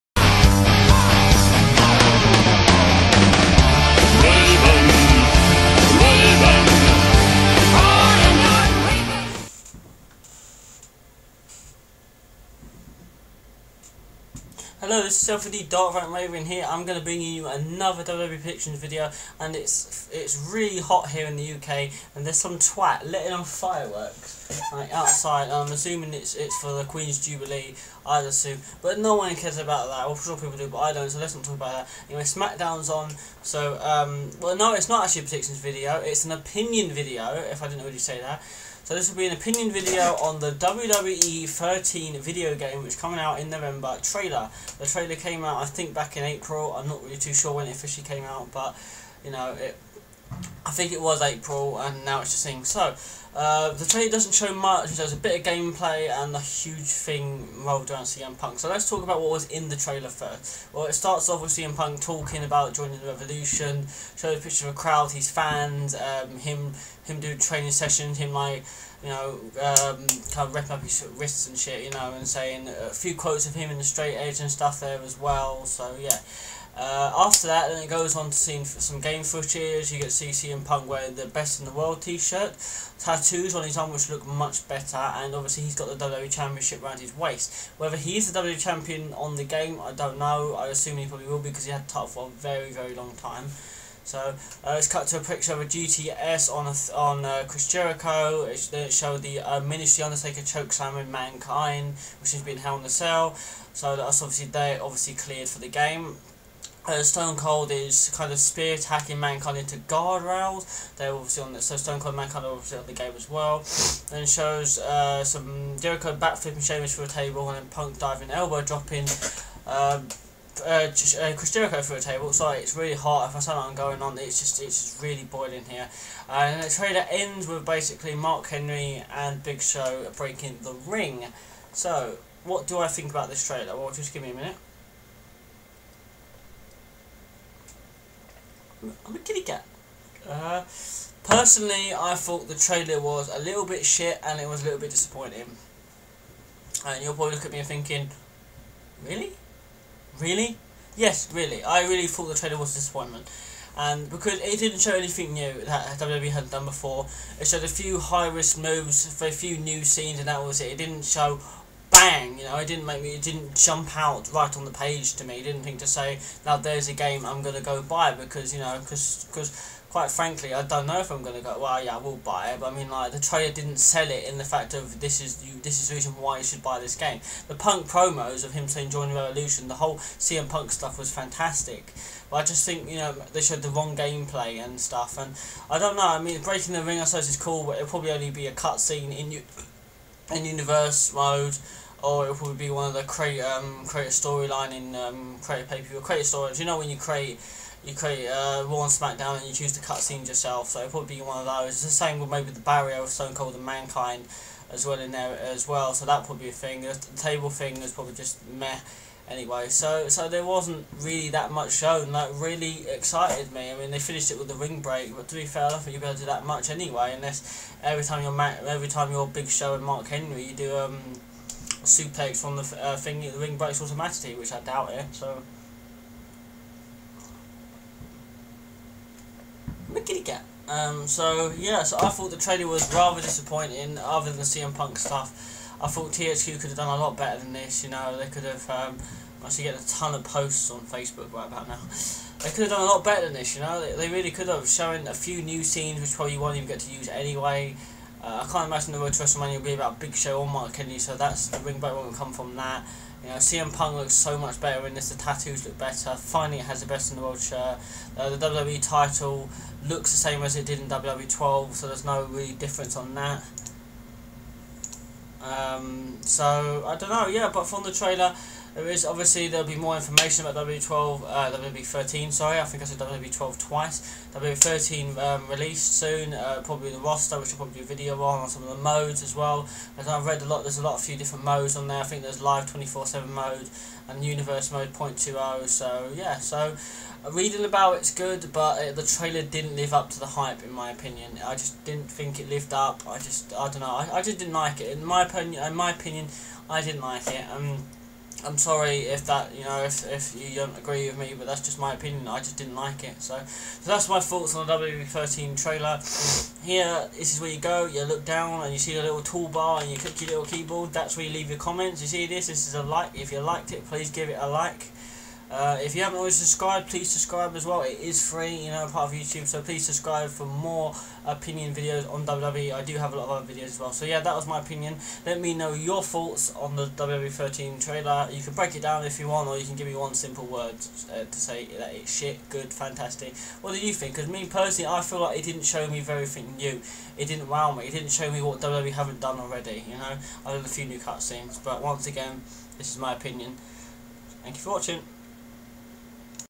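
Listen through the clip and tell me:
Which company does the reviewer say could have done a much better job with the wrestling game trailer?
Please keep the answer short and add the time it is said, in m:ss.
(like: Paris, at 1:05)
THQ, at 3:56.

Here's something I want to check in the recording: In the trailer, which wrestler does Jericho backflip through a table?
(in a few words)
Sheamus.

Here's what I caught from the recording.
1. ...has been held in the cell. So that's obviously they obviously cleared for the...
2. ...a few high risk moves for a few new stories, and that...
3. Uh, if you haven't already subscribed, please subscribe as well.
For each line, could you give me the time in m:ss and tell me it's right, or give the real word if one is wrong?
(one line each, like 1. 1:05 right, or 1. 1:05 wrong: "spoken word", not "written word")
1. 1:42 right
2. 2:37 wrong: "scenes", not "stories"
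3. 5:15 right.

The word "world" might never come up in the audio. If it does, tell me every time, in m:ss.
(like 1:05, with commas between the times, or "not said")
1:21, 4:17.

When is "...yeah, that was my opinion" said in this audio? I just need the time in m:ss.
5:24.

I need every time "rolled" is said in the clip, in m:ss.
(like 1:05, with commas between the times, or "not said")
0:57.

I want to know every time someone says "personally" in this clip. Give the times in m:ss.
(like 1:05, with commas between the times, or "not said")
2:21, 5:34.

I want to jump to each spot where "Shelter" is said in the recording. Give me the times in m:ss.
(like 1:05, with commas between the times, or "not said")
not said.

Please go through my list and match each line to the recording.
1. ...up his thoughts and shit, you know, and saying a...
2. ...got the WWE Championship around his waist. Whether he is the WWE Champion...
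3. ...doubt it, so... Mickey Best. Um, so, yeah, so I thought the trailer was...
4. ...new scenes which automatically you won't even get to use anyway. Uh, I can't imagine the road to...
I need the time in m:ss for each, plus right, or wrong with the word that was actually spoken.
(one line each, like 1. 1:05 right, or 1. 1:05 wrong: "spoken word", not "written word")
1. 1:10 wrong: "wrists", not "thoughts"
2. 1:25 right
3. 3:44 wrong: "Cat", not "Best"
4. 4:05 wrong: "probably", not "automatically".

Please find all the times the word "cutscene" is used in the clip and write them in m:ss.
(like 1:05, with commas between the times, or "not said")
3:08, 5:40.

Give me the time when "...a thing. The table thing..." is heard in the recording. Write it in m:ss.
3:26.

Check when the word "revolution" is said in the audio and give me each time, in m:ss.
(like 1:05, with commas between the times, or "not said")
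1:03, 2:59.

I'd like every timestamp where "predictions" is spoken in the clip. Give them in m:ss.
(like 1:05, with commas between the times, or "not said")
0:18, 0:35.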